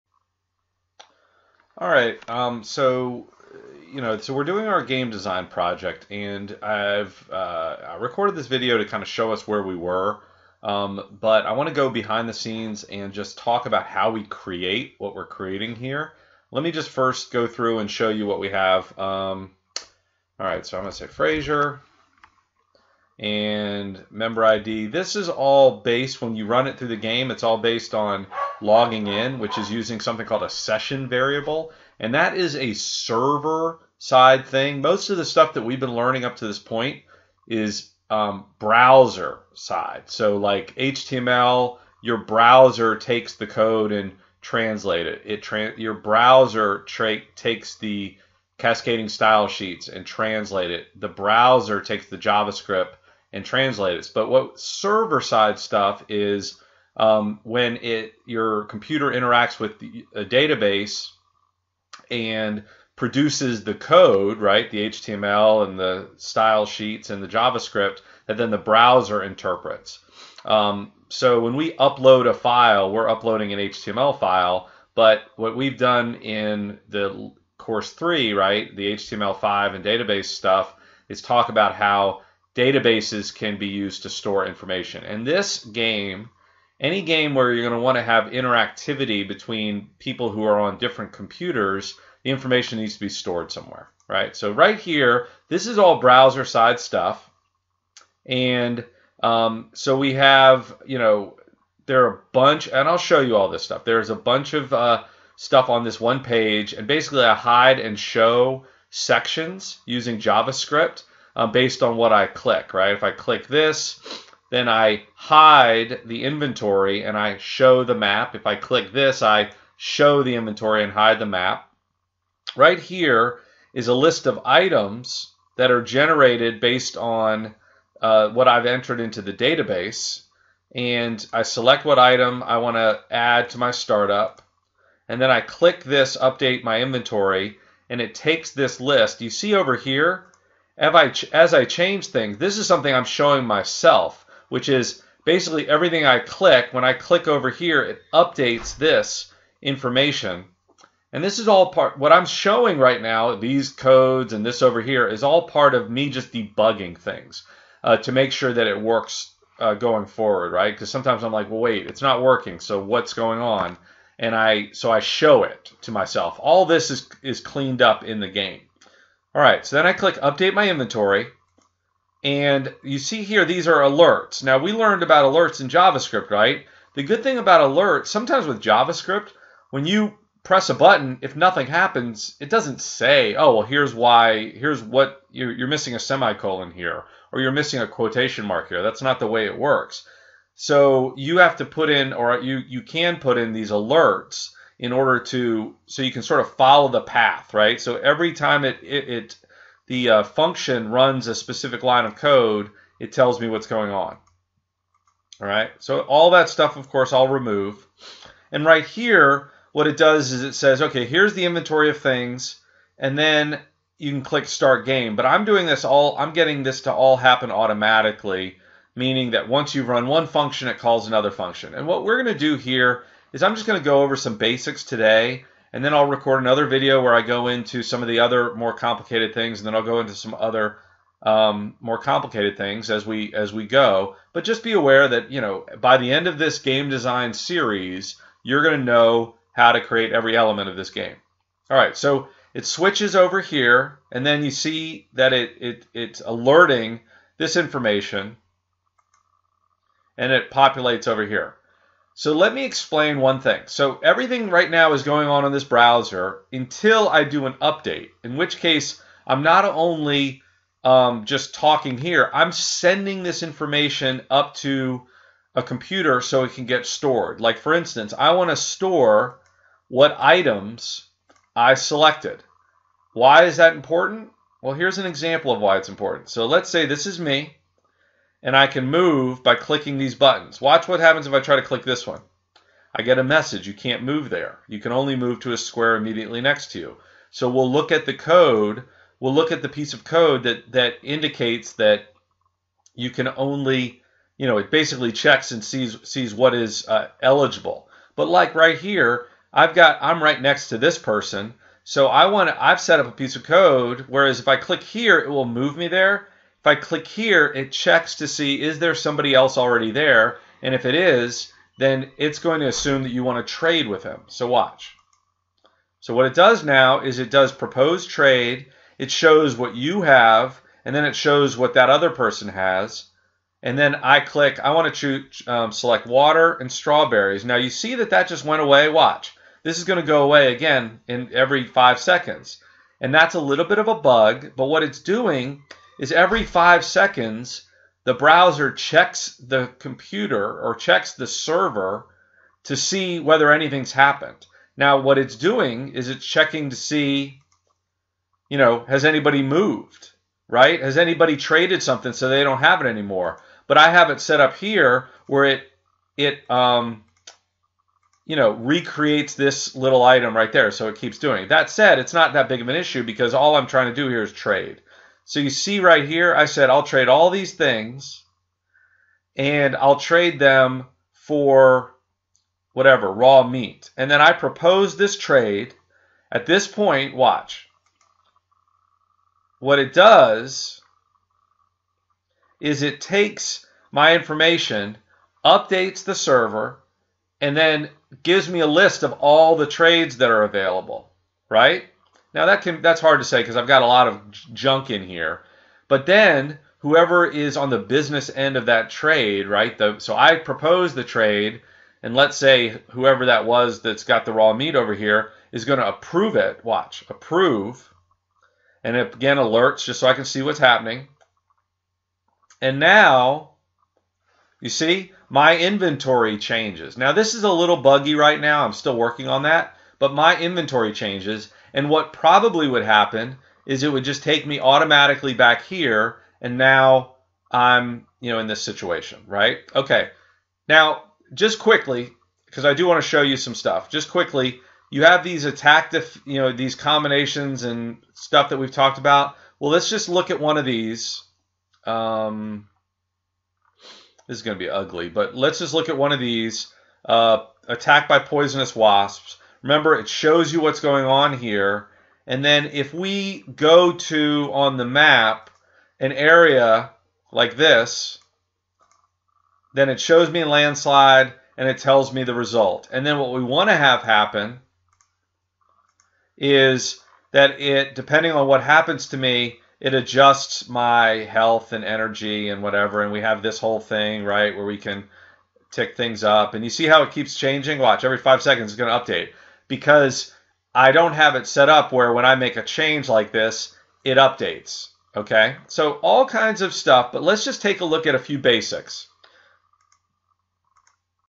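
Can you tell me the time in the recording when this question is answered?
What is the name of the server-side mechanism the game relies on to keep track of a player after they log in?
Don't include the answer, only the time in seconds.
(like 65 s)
30 s.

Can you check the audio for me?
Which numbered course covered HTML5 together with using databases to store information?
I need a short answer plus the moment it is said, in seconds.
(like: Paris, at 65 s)
course three, at 77 s.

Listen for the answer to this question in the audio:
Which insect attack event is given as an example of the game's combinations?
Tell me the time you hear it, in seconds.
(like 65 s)
448 s.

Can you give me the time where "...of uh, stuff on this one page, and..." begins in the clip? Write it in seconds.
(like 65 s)
104 s.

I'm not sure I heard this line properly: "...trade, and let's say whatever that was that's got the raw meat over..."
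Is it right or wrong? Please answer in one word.
wrong.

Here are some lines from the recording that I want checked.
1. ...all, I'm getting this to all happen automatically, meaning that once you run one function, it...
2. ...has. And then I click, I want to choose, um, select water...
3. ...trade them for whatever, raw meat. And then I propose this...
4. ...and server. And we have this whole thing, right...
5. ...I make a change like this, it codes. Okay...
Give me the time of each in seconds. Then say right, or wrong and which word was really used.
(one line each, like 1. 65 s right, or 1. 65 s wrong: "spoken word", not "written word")
1. 215 s right
2. 322 s right
3. 369 s right
4. 472 s wrong: "whatever", not "server"
5. 482 s wrong: "updates", not "codes".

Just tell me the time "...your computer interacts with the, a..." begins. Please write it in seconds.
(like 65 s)
58 s.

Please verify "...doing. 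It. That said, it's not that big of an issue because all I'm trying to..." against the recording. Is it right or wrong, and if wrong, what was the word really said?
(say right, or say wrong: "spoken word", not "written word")
right.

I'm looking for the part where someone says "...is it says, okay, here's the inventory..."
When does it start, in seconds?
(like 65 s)
210 s.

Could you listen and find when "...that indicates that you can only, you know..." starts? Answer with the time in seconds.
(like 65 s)
290 s.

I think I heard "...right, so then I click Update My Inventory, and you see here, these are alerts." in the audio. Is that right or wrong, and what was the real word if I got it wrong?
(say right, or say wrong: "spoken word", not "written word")
right.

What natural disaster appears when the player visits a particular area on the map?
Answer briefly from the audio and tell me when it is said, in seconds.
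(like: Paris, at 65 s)
landslide, at 460 s.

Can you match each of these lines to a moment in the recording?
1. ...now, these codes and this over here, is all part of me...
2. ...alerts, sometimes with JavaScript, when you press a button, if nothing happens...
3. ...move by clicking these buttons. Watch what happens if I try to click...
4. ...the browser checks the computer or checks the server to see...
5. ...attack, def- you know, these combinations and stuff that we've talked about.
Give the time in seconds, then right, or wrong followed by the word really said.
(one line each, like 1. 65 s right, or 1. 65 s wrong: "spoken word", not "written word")
1. 153 s right
2. 177 s right
3. 278 s right
4. 338 s right
5. 435 s right.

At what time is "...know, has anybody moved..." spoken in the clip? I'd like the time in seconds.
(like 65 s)
348 s.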